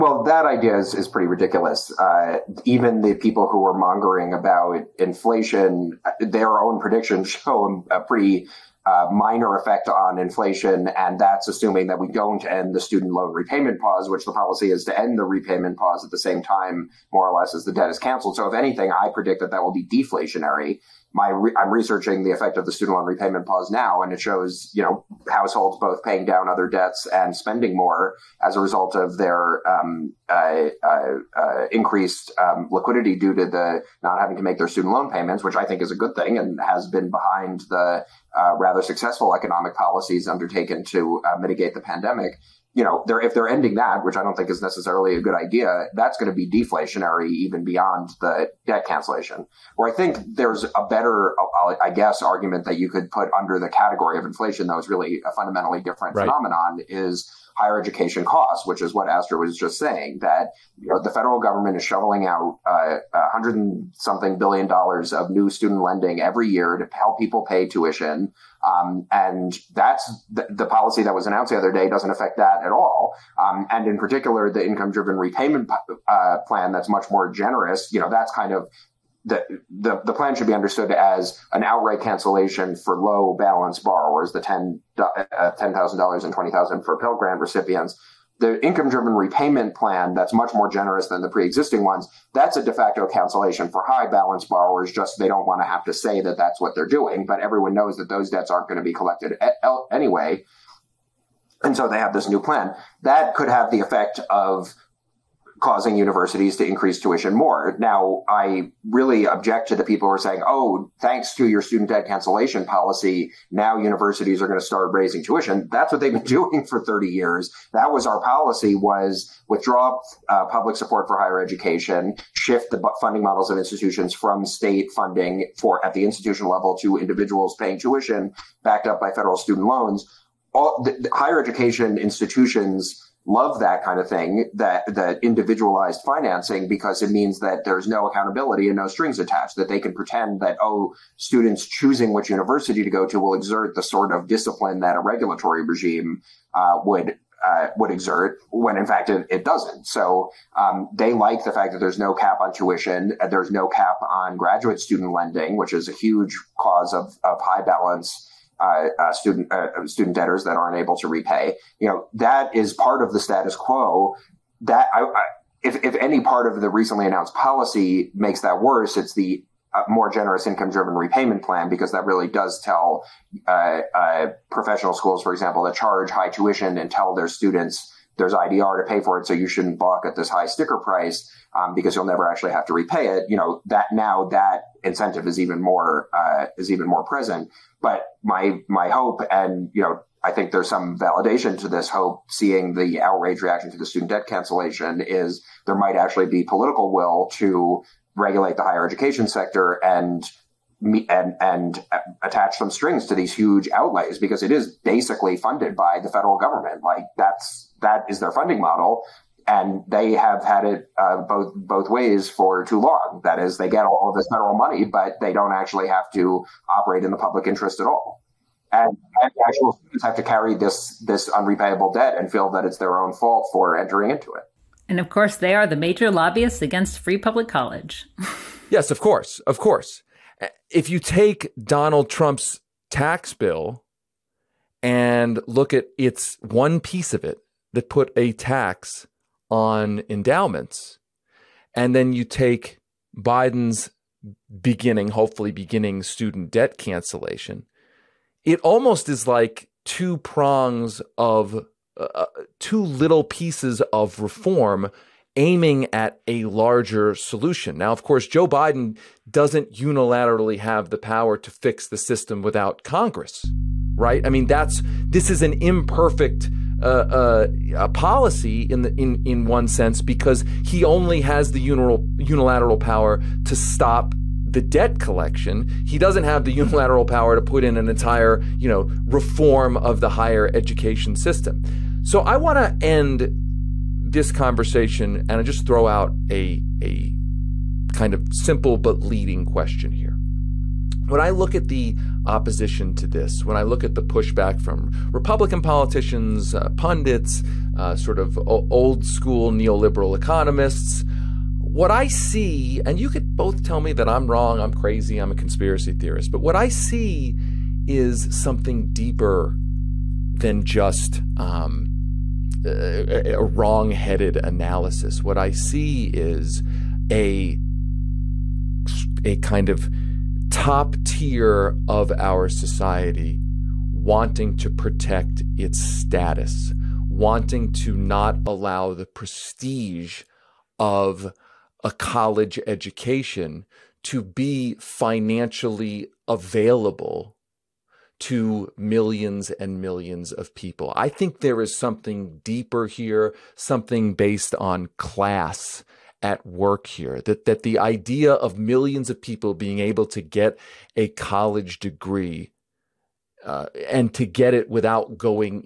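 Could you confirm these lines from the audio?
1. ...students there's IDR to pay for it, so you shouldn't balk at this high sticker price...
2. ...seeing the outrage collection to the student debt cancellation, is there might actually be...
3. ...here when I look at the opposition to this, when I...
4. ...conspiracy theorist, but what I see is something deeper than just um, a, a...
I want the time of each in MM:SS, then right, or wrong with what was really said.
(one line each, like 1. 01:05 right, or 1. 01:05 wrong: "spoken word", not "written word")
1. 02:57 right
2. 03:12 wrong: "reaction", not "collection"
3. 04:49 right
4. 05:05 right.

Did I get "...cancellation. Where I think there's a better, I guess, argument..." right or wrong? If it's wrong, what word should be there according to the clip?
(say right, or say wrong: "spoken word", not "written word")
right.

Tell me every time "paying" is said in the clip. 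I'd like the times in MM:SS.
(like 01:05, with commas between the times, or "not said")
00:26, 02:07.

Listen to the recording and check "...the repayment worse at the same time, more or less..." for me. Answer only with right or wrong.
wrong.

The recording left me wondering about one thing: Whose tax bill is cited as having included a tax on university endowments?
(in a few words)
Donald Trump.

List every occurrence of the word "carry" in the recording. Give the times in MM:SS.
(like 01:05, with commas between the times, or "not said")
03:40.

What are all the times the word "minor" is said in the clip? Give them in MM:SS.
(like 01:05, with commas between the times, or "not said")
00:09.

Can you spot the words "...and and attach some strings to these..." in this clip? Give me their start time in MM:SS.
03:21.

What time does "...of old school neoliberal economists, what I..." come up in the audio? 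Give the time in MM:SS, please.
04:58.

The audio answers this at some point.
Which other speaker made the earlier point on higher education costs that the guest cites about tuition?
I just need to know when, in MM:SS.
00:59.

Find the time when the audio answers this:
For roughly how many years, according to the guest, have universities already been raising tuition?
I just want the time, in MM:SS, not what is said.
01:56.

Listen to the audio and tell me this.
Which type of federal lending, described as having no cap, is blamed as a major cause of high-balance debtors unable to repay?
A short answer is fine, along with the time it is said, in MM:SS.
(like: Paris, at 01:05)
graduate student lending, at 02:34.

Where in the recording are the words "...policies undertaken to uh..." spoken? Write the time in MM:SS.
00:39.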